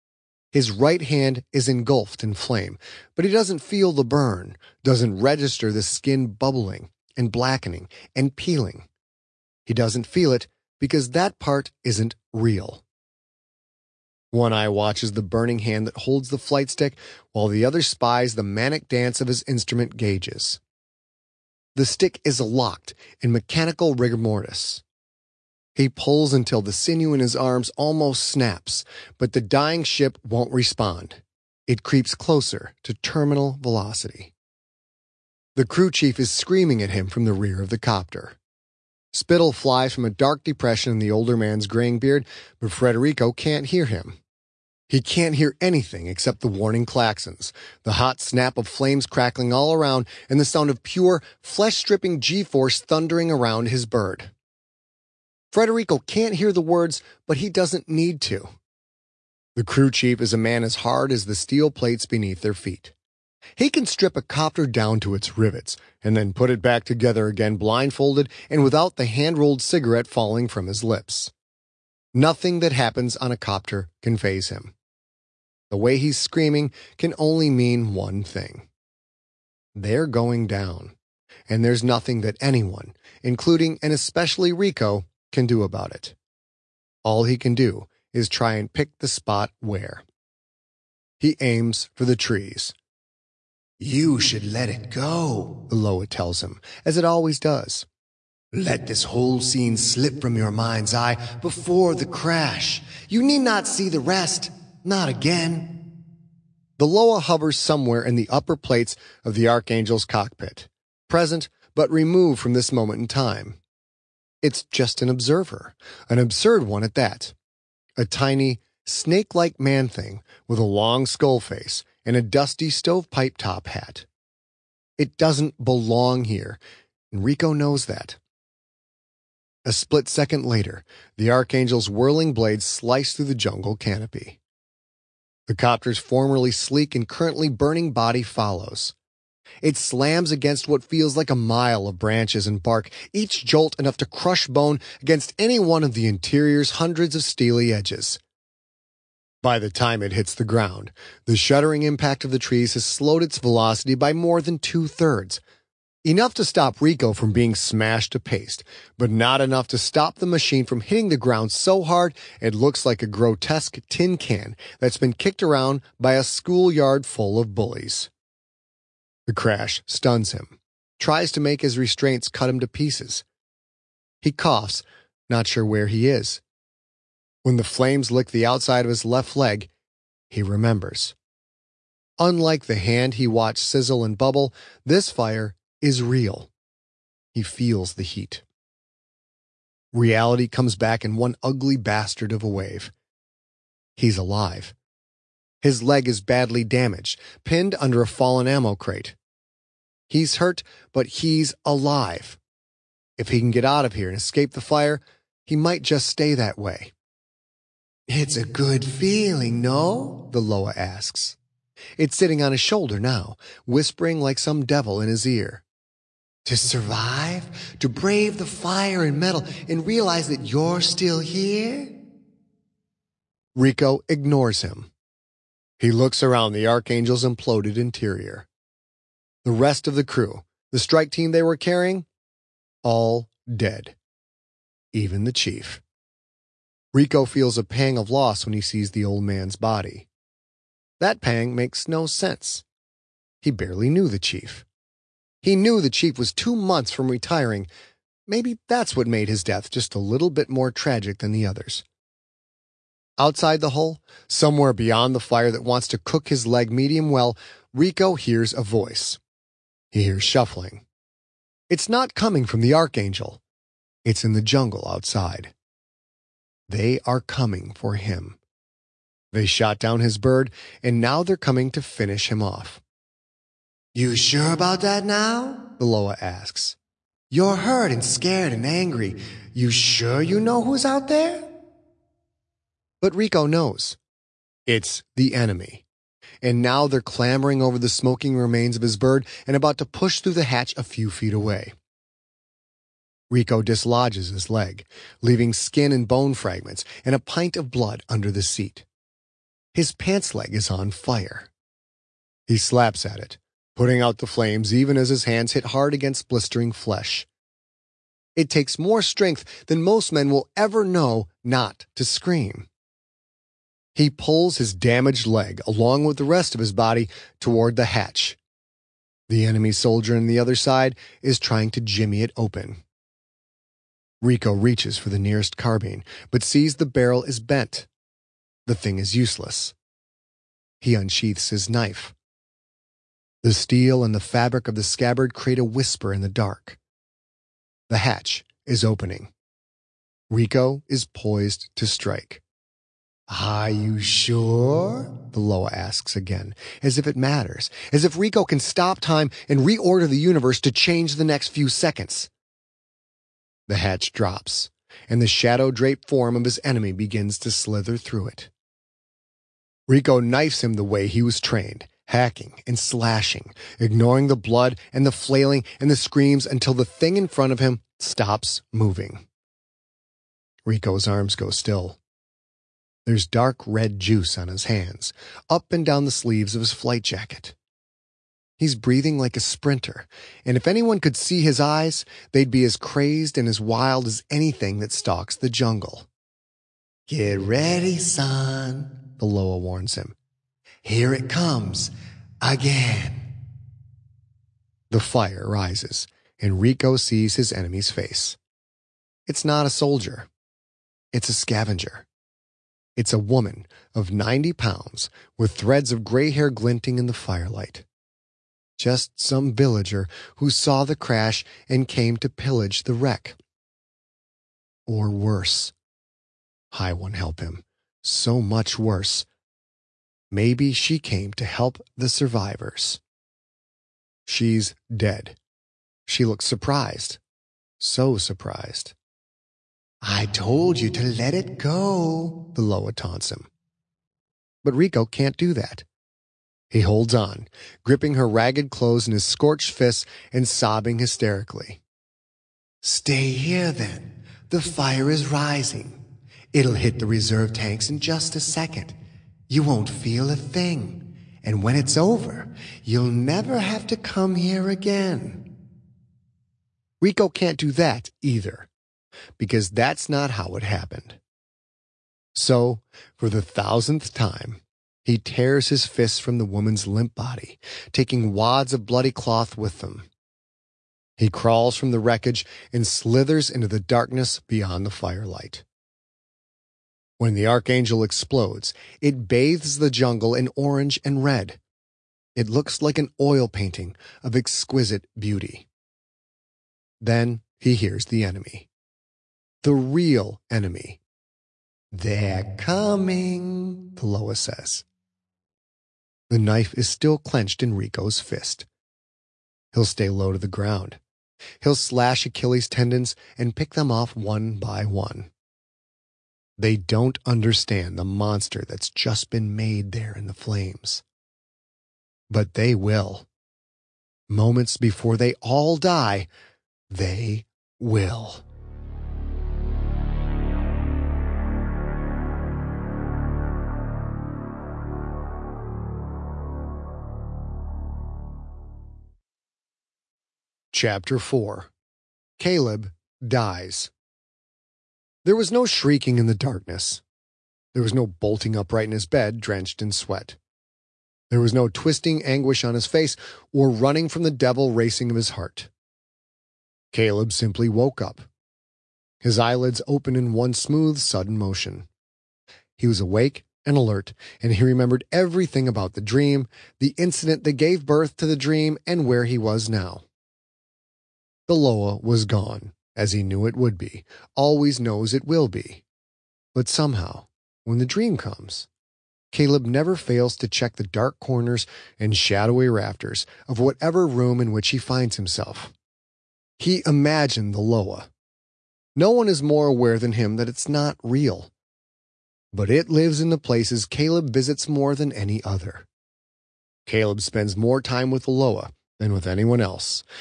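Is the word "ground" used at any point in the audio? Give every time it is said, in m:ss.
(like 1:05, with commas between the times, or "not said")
2:30, 2:41, 8:20.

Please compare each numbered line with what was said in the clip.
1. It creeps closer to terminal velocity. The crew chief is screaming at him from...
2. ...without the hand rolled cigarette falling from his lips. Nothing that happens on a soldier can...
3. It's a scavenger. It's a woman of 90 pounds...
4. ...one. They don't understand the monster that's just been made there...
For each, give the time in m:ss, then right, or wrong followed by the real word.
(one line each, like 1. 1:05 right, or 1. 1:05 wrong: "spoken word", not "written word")
1. 0:31 right
2. 1:08 wrong: "copter", not "soldier"
3. 6:41 right
4. 8:24 right.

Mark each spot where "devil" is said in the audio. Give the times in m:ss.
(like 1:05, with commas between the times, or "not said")
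3:34, 9:04.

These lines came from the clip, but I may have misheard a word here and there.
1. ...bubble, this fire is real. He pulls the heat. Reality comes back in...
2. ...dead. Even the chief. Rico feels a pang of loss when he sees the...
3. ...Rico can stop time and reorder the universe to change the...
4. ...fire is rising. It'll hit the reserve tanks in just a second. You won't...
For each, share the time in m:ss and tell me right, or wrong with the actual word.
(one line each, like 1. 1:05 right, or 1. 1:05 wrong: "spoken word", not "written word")
1. 3:04 wrong: "feels", not "pulls"
2. 3:53 right
3. 5:48 right
4. 7:24 right.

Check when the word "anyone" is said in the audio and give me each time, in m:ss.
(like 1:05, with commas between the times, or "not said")
1:22, 6:20, 9:49.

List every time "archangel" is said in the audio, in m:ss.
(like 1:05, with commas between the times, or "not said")
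1:49, 2:11, 3:46, 4:22, 7:57.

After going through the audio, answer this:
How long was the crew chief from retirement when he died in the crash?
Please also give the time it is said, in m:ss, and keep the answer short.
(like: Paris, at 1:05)
two months, at 4:06.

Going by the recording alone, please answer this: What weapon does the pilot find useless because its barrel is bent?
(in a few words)
carbine.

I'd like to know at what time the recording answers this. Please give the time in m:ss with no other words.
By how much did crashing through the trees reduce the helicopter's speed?
2:34.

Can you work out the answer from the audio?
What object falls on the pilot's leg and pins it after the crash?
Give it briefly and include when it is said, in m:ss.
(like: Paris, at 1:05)
ammo crate, at 3:18.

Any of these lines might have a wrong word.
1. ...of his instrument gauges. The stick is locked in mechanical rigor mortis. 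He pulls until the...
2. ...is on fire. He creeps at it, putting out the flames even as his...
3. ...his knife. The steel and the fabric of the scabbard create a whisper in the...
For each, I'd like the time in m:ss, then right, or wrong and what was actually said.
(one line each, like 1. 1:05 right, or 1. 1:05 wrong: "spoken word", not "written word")
1. 0:19 right
2. 5:00 wrong: "slaps", not "creeps"
3. 5:31 right.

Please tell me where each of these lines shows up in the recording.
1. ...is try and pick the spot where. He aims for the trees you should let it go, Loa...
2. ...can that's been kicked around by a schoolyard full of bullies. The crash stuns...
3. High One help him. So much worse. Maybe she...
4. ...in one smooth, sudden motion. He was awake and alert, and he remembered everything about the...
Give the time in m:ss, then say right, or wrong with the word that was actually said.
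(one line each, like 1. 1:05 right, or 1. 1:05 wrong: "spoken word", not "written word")
1. 1:28 right
2. 2:44 right
3. 6:56 right
4. 9:10 right.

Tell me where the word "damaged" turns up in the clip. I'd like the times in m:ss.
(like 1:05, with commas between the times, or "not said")
3:16, 5:14.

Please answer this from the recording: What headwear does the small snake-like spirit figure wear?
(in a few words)
stovepipe top hat.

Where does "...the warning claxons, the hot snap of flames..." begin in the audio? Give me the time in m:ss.
0:46.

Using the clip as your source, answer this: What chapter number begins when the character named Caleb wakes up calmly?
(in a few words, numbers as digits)
4.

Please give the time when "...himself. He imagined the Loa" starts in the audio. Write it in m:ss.
9:35.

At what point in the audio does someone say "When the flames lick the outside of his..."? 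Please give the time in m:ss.
2:57.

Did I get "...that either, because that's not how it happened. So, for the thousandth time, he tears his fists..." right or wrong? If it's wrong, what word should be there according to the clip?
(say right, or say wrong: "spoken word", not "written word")
right.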